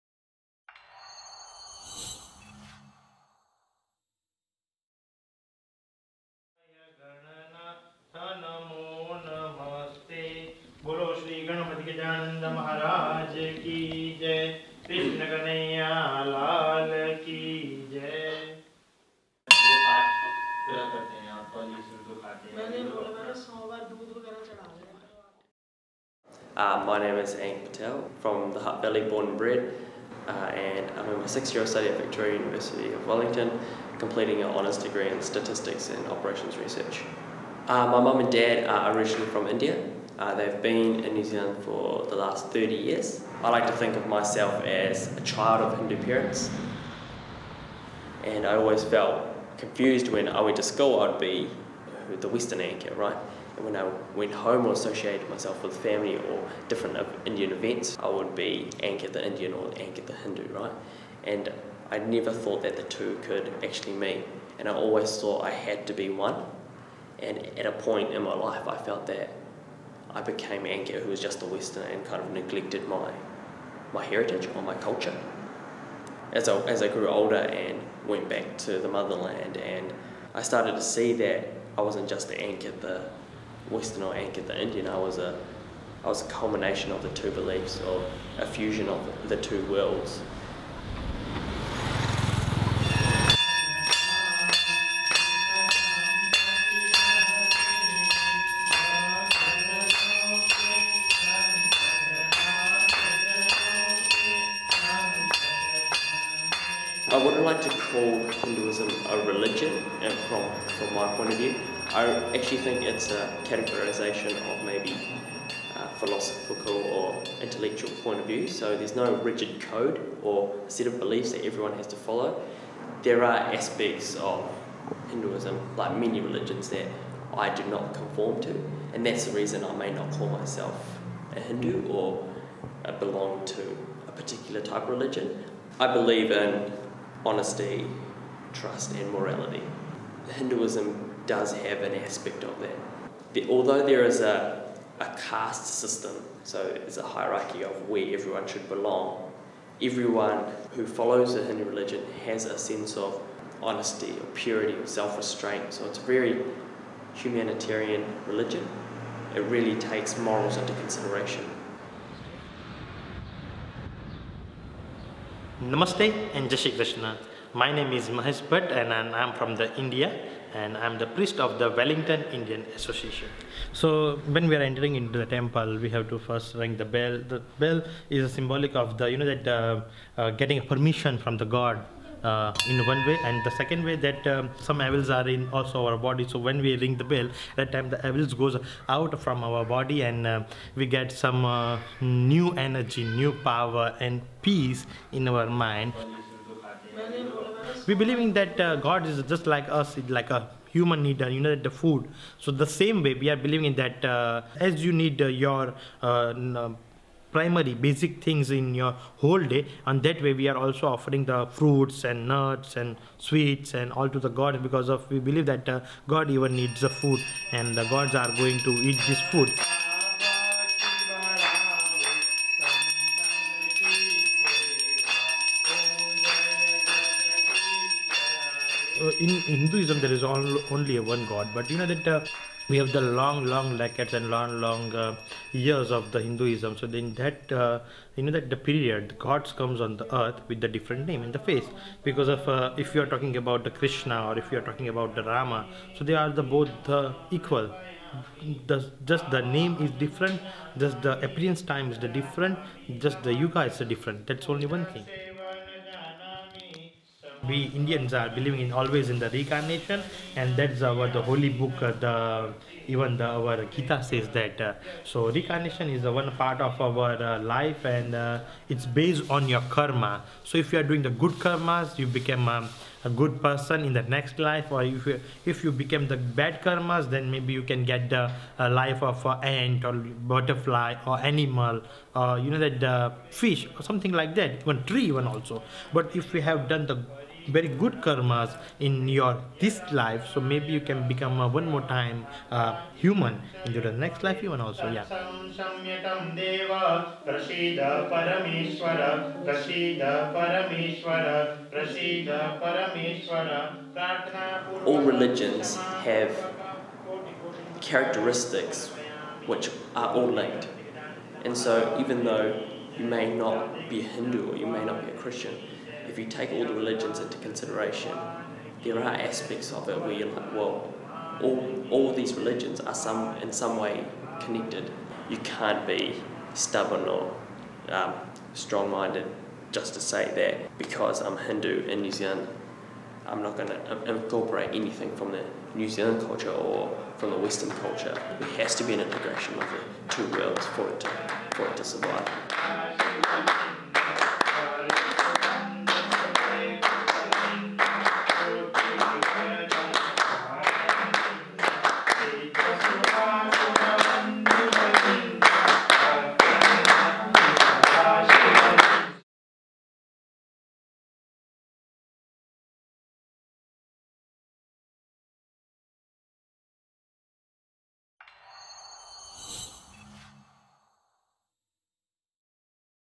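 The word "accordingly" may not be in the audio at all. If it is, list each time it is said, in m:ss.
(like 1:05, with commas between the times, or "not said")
not said.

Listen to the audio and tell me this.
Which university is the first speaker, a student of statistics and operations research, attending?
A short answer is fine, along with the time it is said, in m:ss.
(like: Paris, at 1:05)
Victoria University of Wellington, at 0:32.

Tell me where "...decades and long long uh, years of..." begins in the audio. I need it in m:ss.
3:53.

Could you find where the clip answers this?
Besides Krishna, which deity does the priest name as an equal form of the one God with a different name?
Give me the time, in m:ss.
4:05.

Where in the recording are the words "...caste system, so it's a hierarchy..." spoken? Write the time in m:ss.
2:25.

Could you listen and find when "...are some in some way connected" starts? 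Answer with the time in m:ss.
5:22.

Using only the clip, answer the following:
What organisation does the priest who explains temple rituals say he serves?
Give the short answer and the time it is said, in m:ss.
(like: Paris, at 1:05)
Wellington Indian Association, at 2:51.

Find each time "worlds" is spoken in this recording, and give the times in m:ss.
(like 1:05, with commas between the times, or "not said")
1:29, 5:40.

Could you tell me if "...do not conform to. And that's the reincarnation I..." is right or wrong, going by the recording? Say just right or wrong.
wrong.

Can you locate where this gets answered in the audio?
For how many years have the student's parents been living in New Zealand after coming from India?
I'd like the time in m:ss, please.
0:42.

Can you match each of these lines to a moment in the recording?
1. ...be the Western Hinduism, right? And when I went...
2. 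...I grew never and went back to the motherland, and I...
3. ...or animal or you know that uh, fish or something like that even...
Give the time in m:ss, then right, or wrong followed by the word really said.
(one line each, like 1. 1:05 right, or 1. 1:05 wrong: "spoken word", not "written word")
1. 0:51 wrong: "Ankit", not "Hinduism"
2. 1:16 wrong: "older", not "never"
3. 4:41 right.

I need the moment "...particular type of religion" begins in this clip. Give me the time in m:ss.
2:14.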